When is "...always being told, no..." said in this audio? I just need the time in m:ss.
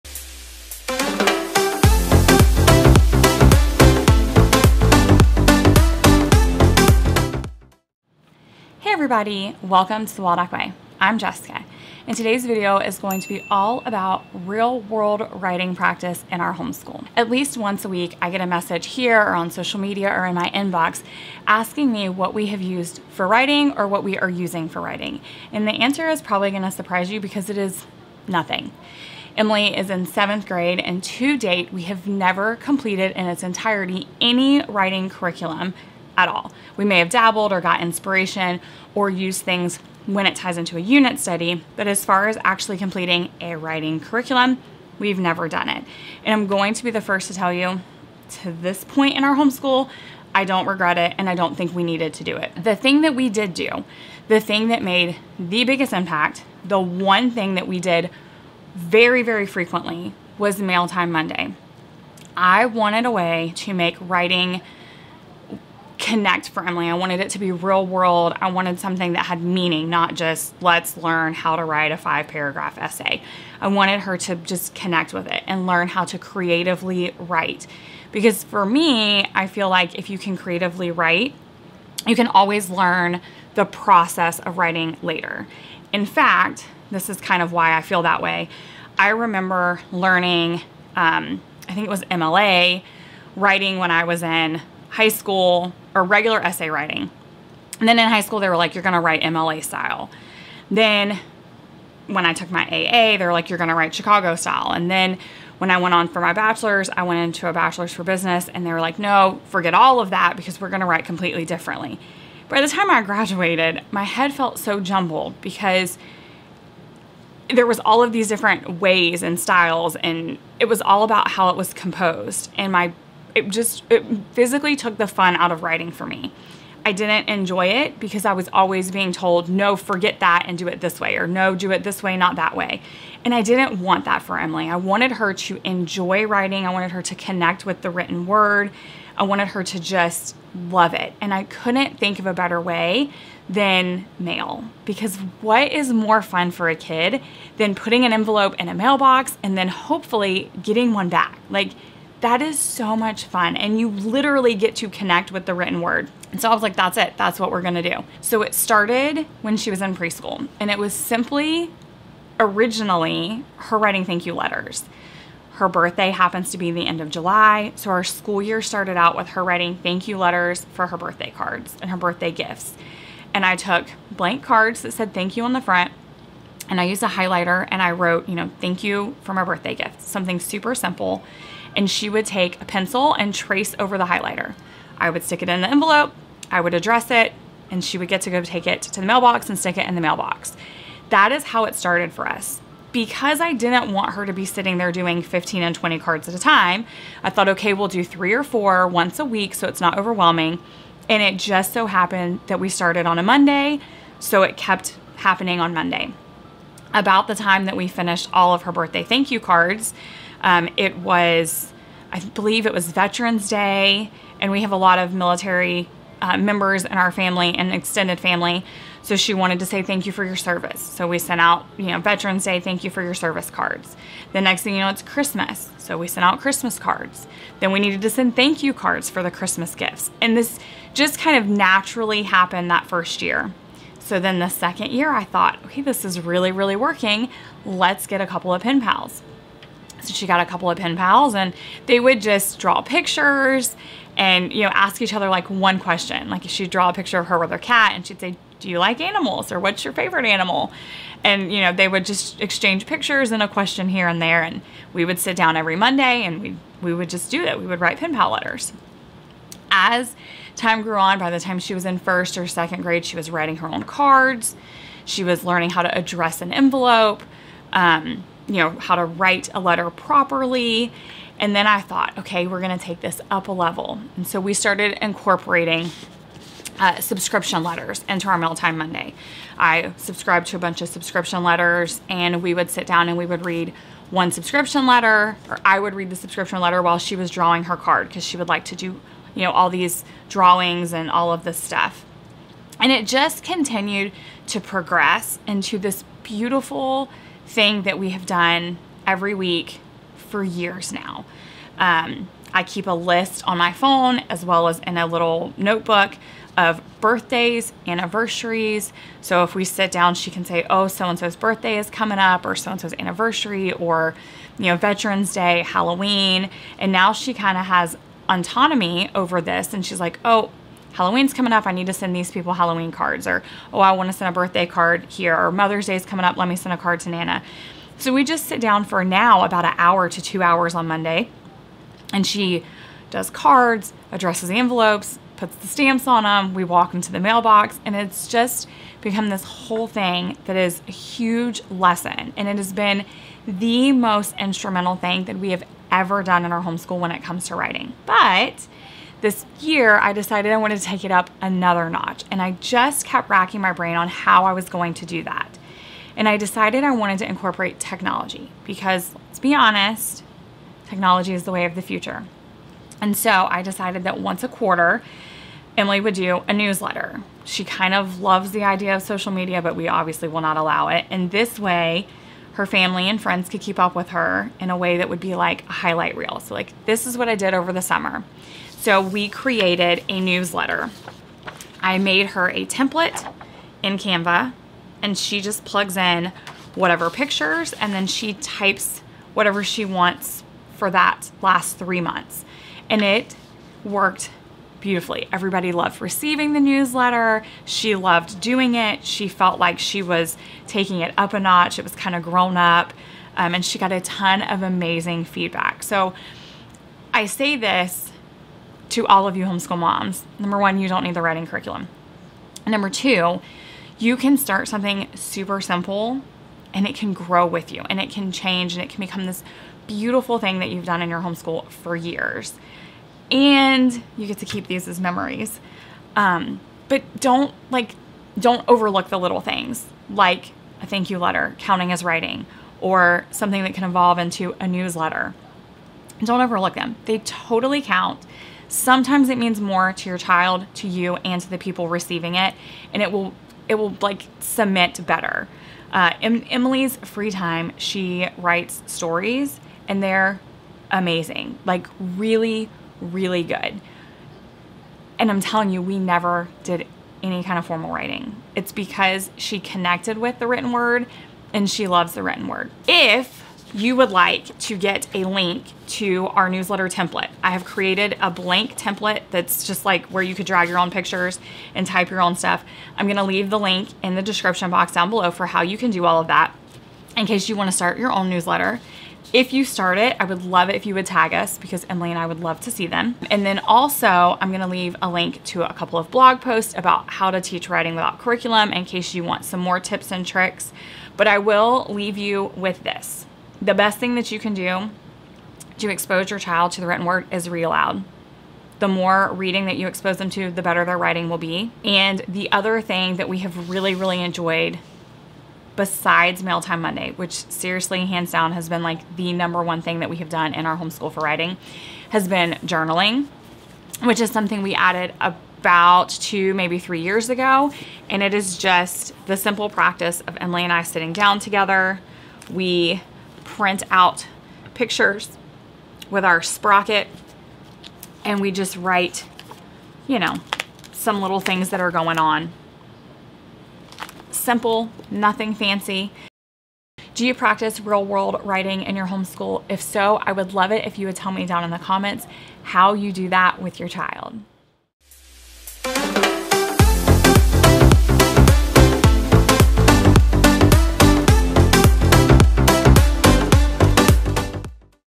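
2:08.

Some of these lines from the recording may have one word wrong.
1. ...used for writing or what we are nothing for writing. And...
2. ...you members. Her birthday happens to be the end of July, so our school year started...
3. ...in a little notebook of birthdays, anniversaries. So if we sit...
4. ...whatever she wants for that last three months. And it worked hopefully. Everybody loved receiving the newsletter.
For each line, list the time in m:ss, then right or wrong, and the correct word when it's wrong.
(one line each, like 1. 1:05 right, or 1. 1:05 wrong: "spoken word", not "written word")
1. 0:22 wrong: "using", not "nothing"
2. 2:44 wrong: "letters", not "members"
3. 5:04 right
4. 6:29 wrong: "beautifully", not "hopefully".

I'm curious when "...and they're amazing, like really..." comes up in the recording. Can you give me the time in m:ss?
7:29.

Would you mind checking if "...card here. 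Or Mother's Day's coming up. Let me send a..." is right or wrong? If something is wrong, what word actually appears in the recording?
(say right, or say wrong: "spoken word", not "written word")
right.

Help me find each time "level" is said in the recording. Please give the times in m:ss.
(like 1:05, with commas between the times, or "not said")
4:33.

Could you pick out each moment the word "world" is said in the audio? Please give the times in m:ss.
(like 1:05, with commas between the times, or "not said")
0:14, 1:07, 8:58.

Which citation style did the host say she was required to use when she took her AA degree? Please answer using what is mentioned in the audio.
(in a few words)
Chicago style.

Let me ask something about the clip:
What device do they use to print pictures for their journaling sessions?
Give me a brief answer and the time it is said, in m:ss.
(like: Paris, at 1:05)
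sprocket, at 8:46.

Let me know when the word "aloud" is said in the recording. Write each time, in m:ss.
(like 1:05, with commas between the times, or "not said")
8:17.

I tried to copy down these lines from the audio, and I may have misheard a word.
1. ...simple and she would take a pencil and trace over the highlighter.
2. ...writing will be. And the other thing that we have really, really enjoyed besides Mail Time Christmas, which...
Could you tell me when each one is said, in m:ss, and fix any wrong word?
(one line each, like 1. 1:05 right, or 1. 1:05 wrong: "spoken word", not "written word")
1. 3:00 right
2. 8:20 wrong: "Monday", not "Christmas".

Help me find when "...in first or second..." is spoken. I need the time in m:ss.
4:21.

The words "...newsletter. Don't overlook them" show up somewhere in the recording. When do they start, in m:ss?
7:14.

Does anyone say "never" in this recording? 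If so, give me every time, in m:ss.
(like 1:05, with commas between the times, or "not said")
0:32, 0:45, 7:35.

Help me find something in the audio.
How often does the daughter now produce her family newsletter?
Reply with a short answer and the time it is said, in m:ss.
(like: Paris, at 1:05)
once a quarter, at 6:04.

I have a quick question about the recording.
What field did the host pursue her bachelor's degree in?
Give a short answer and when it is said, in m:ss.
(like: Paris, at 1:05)
business, at 1:48.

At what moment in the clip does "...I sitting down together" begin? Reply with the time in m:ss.
8:40.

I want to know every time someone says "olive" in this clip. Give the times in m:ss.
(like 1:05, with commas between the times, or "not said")
not said.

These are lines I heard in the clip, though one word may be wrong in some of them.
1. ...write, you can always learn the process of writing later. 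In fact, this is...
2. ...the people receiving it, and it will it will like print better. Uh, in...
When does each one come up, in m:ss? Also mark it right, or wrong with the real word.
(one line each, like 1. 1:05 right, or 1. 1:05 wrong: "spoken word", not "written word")
1. 1:20 right
2. 7:21 wrong: "cement", not "print".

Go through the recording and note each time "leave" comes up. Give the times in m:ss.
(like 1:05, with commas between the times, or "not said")
7:53, 8:04, 8:11.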